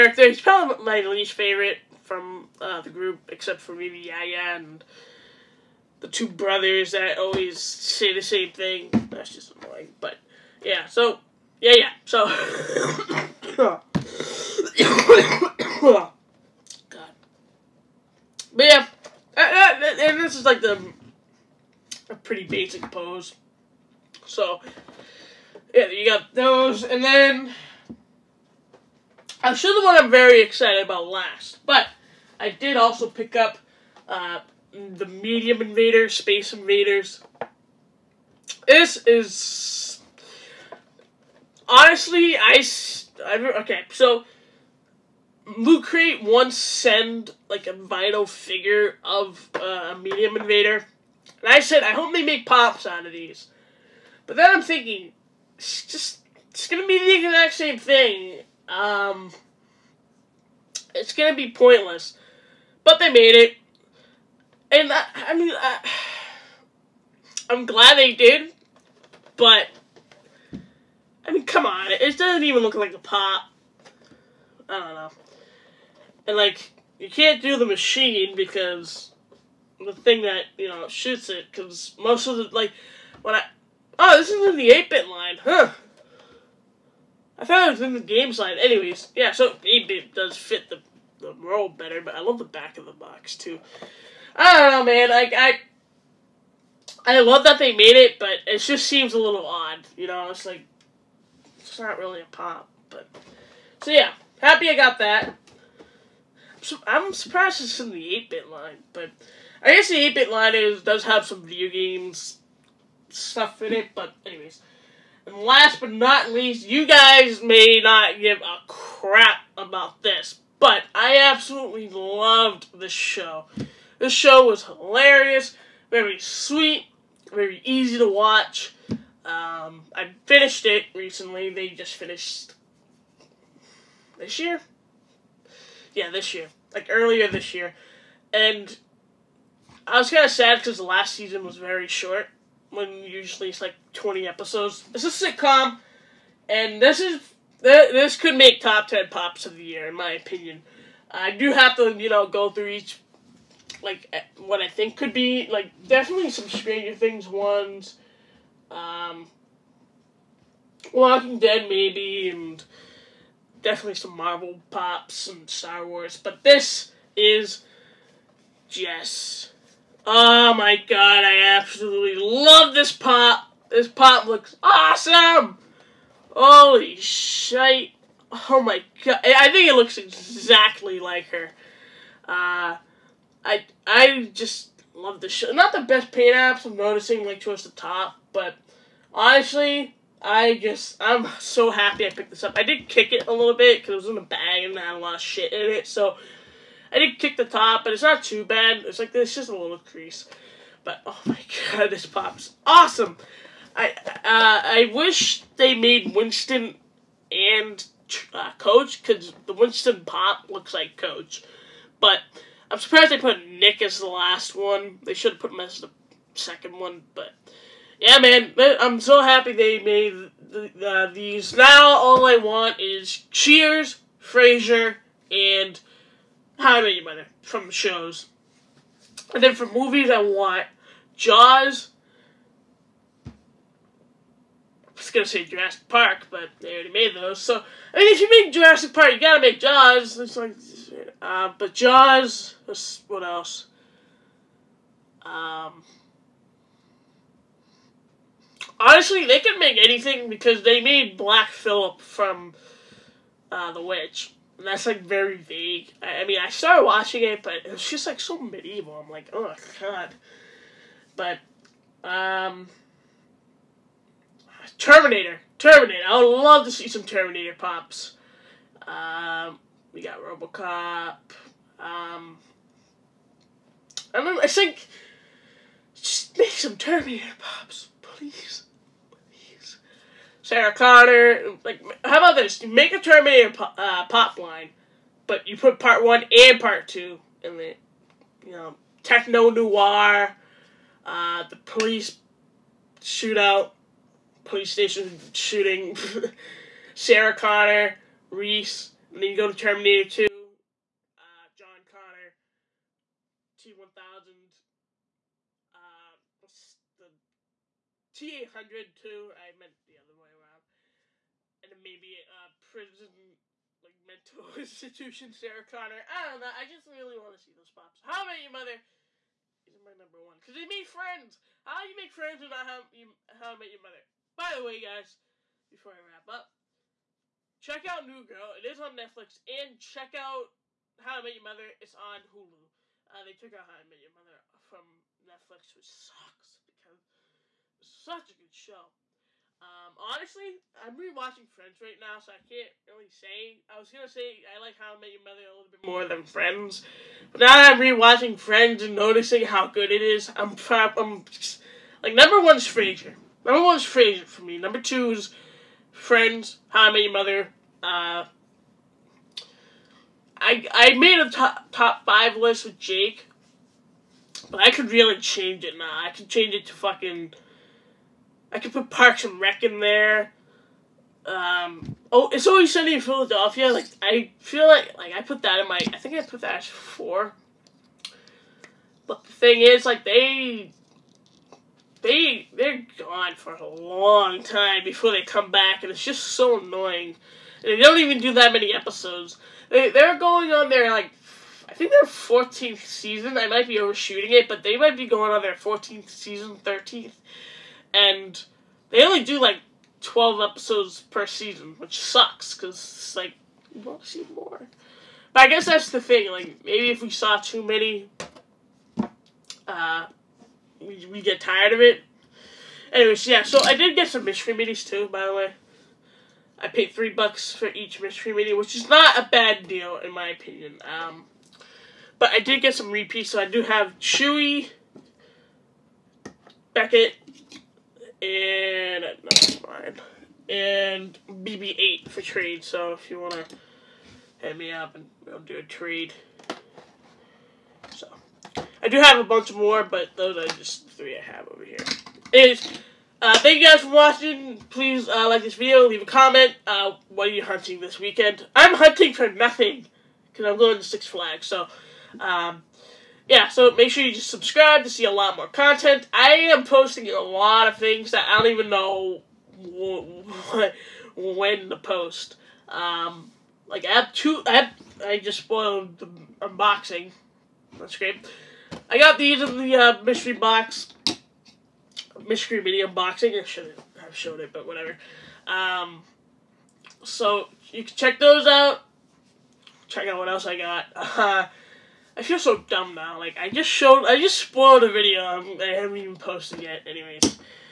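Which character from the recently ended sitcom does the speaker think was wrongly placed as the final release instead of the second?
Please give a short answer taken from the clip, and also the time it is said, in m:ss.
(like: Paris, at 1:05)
Nick, at 3:33.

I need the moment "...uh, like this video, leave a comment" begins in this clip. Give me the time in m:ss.
7:25.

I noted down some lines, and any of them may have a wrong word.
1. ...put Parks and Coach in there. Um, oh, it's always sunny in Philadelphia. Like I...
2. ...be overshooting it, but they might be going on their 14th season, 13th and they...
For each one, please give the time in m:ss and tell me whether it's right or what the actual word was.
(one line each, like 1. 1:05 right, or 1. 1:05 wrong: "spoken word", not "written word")
1. 6:08 wrong: "Rec", not "Coach"
2. 6:33 right.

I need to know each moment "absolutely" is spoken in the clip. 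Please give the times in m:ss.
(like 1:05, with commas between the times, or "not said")
2:01, 2:51.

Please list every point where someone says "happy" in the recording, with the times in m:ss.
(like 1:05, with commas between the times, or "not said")
1:44, 3:11, 3:39.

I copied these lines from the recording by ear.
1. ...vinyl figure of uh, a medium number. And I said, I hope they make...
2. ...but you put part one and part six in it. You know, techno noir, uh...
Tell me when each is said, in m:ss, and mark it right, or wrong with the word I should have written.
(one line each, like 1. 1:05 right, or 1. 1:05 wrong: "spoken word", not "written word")
1. 0:47 wrong: "invader", not "number"
2. 4:45 wrong: "two", not "six".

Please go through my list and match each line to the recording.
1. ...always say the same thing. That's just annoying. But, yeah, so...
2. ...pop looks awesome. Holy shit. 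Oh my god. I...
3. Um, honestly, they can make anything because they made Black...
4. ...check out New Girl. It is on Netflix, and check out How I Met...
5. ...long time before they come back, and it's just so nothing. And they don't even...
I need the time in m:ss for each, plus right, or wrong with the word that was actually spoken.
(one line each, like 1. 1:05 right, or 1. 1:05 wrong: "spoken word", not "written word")
1. 0:07 right
2. 2:53 right
3. 4:05 right
4. 5:27 right
5. 6:23 wrong: "annoying", not "nothing".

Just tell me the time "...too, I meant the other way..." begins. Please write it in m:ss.
5:08.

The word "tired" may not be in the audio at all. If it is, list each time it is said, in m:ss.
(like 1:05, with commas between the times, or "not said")
6:51.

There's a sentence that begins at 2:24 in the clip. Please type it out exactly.
It's a sitcom, and this is this could make top 10 pops of the year in my opinion.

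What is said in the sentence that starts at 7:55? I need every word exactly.
Um, so you can check those out.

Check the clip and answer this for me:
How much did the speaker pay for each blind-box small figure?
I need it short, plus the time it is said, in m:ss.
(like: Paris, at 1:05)
$3, at 6:56.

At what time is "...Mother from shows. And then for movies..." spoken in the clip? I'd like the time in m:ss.
3:47.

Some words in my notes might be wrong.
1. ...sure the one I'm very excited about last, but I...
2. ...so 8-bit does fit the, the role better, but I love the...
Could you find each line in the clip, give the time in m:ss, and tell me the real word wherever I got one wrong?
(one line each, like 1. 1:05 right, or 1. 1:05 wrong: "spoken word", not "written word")
1. 0:29 right
2. 1:29 right.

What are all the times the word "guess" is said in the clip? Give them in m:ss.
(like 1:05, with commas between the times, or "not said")
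1:49, 6:45.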